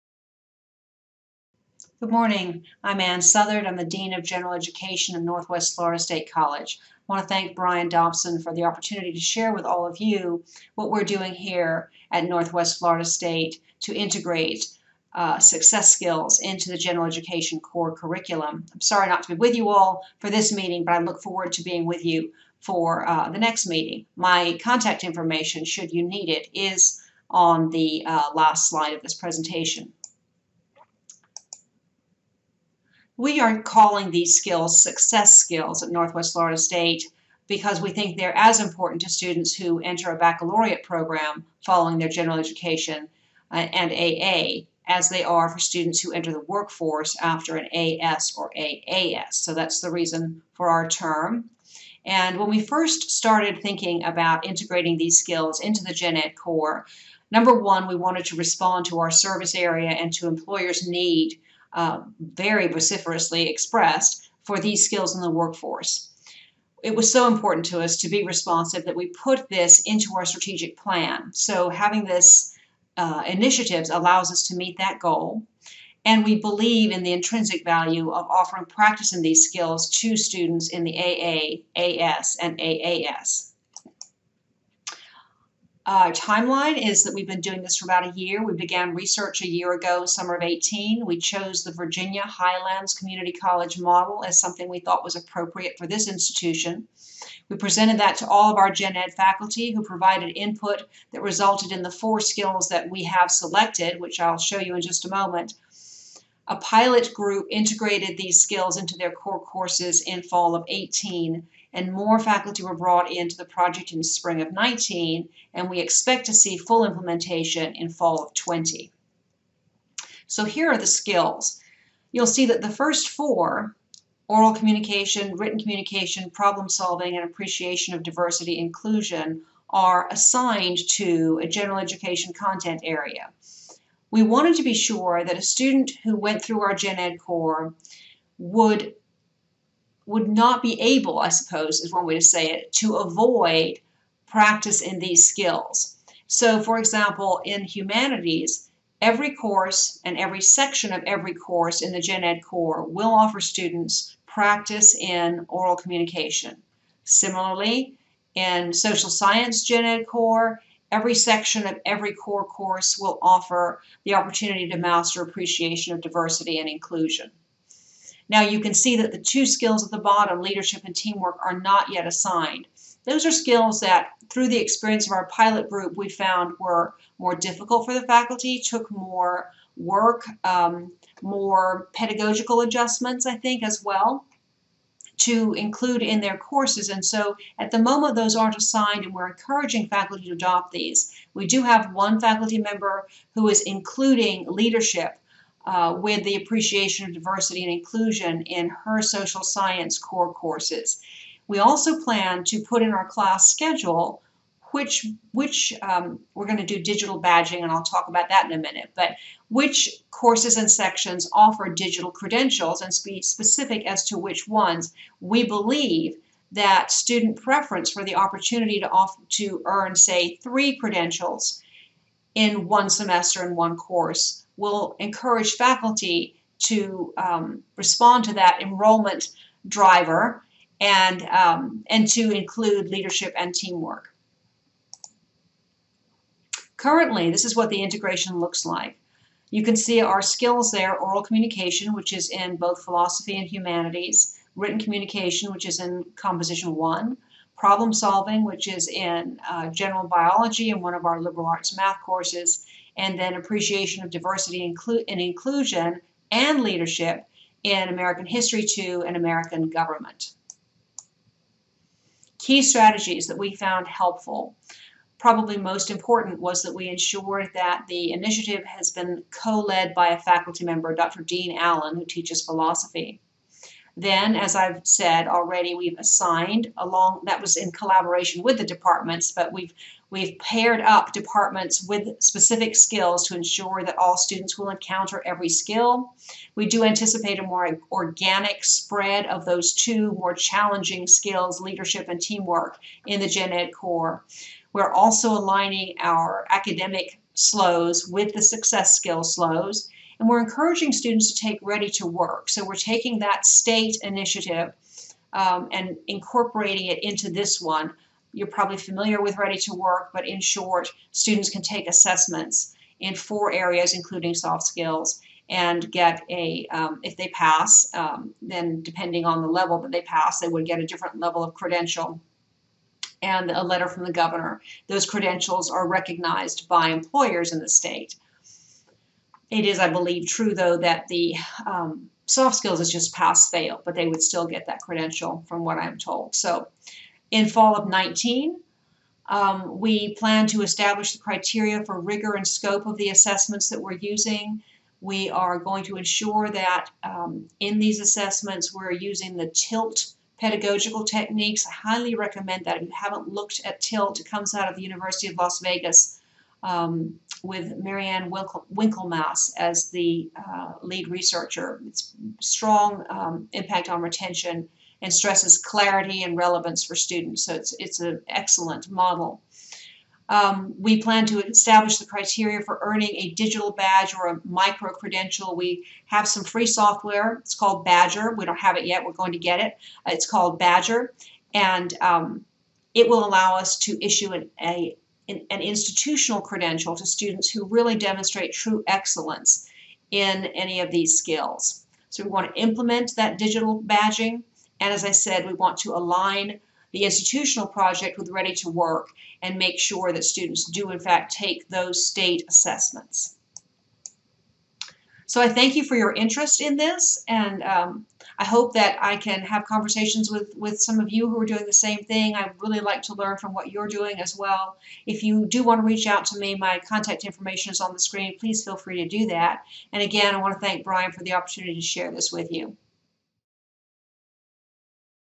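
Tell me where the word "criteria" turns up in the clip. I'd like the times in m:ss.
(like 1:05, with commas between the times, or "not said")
5:41, 6:12.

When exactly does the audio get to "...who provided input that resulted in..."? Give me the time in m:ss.
1:39.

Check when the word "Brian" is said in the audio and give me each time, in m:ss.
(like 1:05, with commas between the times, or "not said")
0:07, 7:00.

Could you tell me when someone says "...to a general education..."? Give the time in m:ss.
2:10.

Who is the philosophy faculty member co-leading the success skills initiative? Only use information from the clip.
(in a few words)
Dr. Dean Allen.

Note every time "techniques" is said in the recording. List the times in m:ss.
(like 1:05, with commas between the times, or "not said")
5:51.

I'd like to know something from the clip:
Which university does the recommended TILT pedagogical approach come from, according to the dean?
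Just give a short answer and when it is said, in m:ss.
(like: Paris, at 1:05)
University of Las Vegas, at 5:54.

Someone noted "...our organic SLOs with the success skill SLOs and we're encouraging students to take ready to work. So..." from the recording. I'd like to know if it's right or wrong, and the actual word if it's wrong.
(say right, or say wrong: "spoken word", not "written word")
wrong: "academic", not "organic".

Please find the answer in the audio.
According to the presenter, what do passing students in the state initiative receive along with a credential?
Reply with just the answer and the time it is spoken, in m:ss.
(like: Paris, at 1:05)
A letter from the governor, at 5:23.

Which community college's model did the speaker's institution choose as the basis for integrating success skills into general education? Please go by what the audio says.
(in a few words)
Virginia Highlands Community College.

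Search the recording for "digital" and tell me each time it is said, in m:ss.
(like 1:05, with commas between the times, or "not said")
3:26, 3:31, 6:13, 6:33.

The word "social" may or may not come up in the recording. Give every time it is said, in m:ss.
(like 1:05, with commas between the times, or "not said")
2:38, 3:19.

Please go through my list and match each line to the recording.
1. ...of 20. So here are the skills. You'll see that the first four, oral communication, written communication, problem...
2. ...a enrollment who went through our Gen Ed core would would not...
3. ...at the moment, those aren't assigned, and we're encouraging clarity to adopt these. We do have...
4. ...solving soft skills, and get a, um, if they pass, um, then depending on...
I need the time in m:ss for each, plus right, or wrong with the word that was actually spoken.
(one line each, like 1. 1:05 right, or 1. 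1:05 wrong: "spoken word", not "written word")
1. 1:58 right
2. 2:15 wrong: "student", not "enrollment"
3. 3:07 wrong: "faculty", not "clarity"
4. 5:13 wrong: "including", not "solving".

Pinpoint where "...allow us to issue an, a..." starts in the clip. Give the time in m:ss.
6:23.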